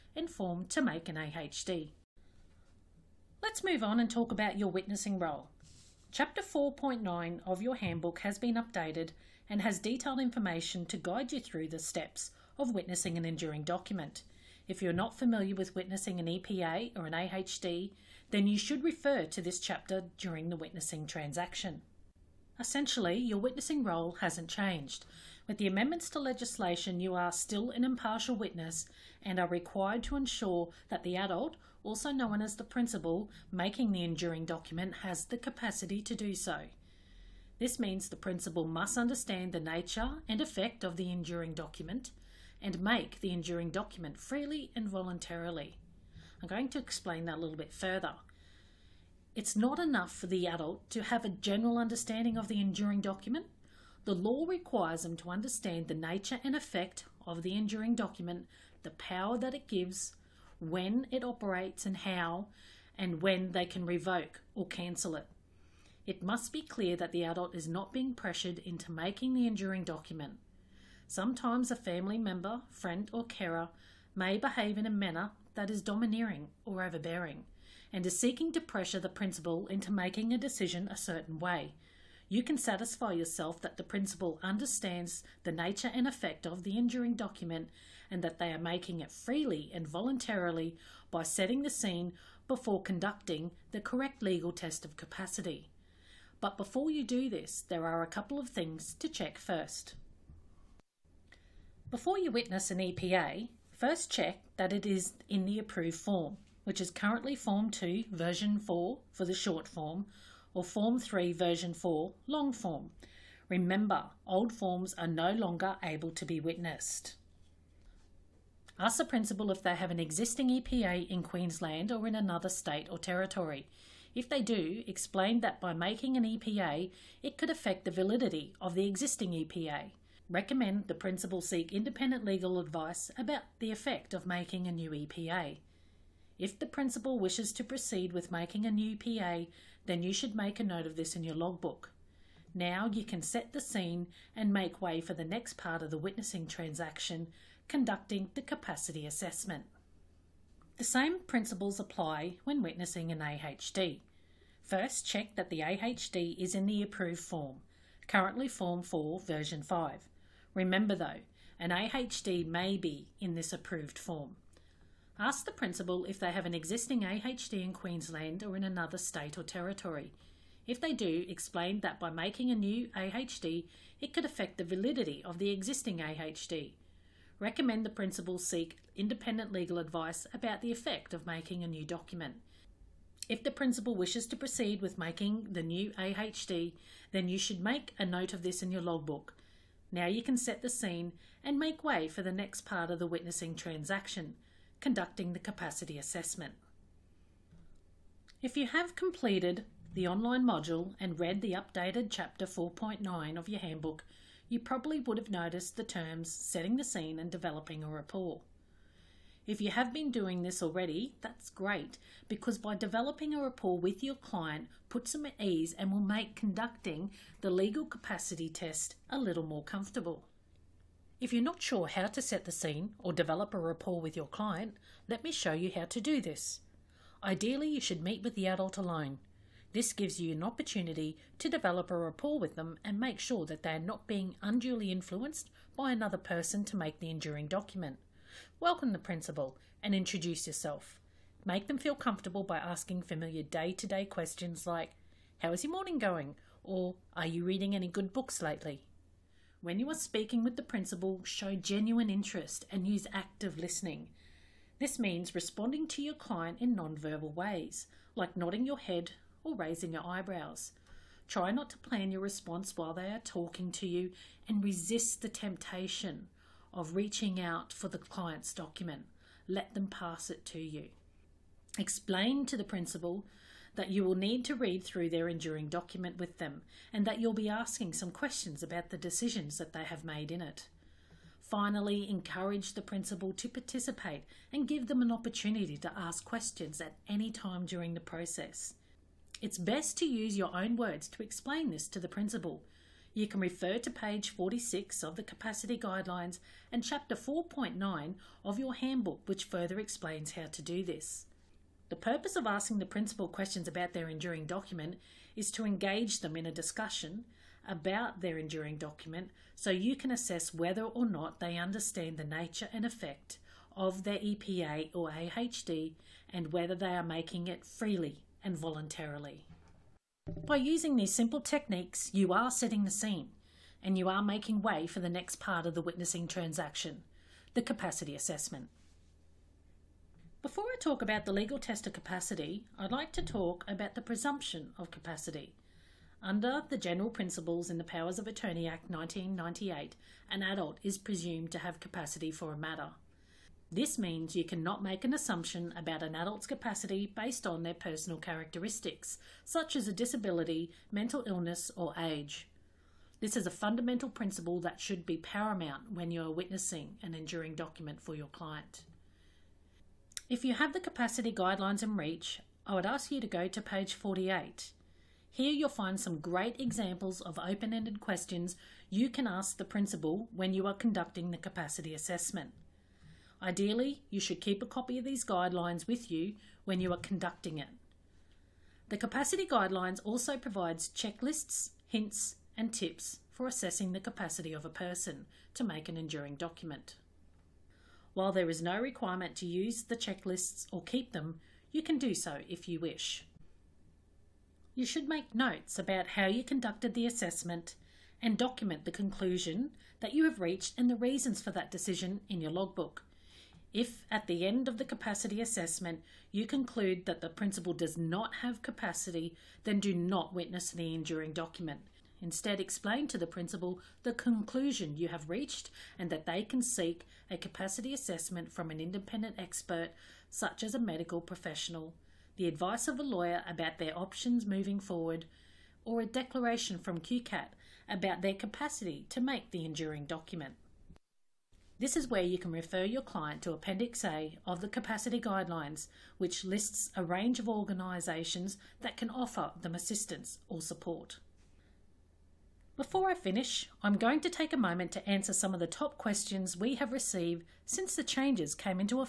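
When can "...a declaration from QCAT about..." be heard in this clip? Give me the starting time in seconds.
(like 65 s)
426 s.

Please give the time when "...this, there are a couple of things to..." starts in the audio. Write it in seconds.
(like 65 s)
97 s.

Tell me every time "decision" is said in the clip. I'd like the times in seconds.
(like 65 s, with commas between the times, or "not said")
80 s, 278 s, 401 s.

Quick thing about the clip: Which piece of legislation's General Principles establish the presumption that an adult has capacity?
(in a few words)
Powers of Attorney Act 1998.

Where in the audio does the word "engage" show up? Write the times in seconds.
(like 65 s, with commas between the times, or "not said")
305 s.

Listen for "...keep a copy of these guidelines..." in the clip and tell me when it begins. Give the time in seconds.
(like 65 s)
374 s.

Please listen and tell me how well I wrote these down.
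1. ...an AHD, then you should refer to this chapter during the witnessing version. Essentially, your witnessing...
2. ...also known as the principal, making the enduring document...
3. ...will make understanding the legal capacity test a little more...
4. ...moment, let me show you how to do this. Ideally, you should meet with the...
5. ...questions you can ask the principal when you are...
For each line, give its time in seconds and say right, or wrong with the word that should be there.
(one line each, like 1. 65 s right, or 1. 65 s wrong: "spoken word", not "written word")
1. 17 s wrong: "transaction", not "version"
2. 31 s right
3. 215 s wrong: "conducting", not "understanding"
4. 224 s wrong: "client", not "moment"
5. 367 s right.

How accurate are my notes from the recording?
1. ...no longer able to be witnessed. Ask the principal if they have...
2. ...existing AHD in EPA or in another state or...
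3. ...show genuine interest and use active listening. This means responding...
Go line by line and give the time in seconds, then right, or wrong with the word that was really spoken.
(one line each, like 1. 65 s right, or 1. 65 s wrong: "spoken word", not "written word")
1. 115 s right
2. 166 s wrong: "Queensland", not "EPA"
3. 251 s right.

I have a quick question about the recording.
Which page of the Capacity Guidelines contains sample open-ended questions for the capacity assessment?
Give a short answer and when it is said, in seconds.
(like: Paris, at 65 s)
48, at 363 s.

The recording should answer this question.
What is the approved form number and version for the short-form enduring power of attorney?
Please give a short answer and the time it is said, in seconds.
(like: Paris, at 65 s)
Form 2 version 4, at 107 s.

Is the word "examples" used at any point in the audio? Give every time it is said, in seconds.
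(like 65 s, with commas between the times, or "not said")
366 s.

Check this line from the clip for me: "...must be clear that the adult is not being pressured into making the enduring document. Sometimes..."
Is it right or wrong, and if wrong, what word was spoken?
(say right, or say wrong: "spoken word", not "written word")
right.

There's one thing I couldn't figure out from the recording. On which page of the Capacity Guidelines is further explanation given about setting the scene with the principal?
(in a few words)
46.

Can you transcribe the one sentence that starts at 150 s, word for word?
The same principles apply when witnessing an AHD.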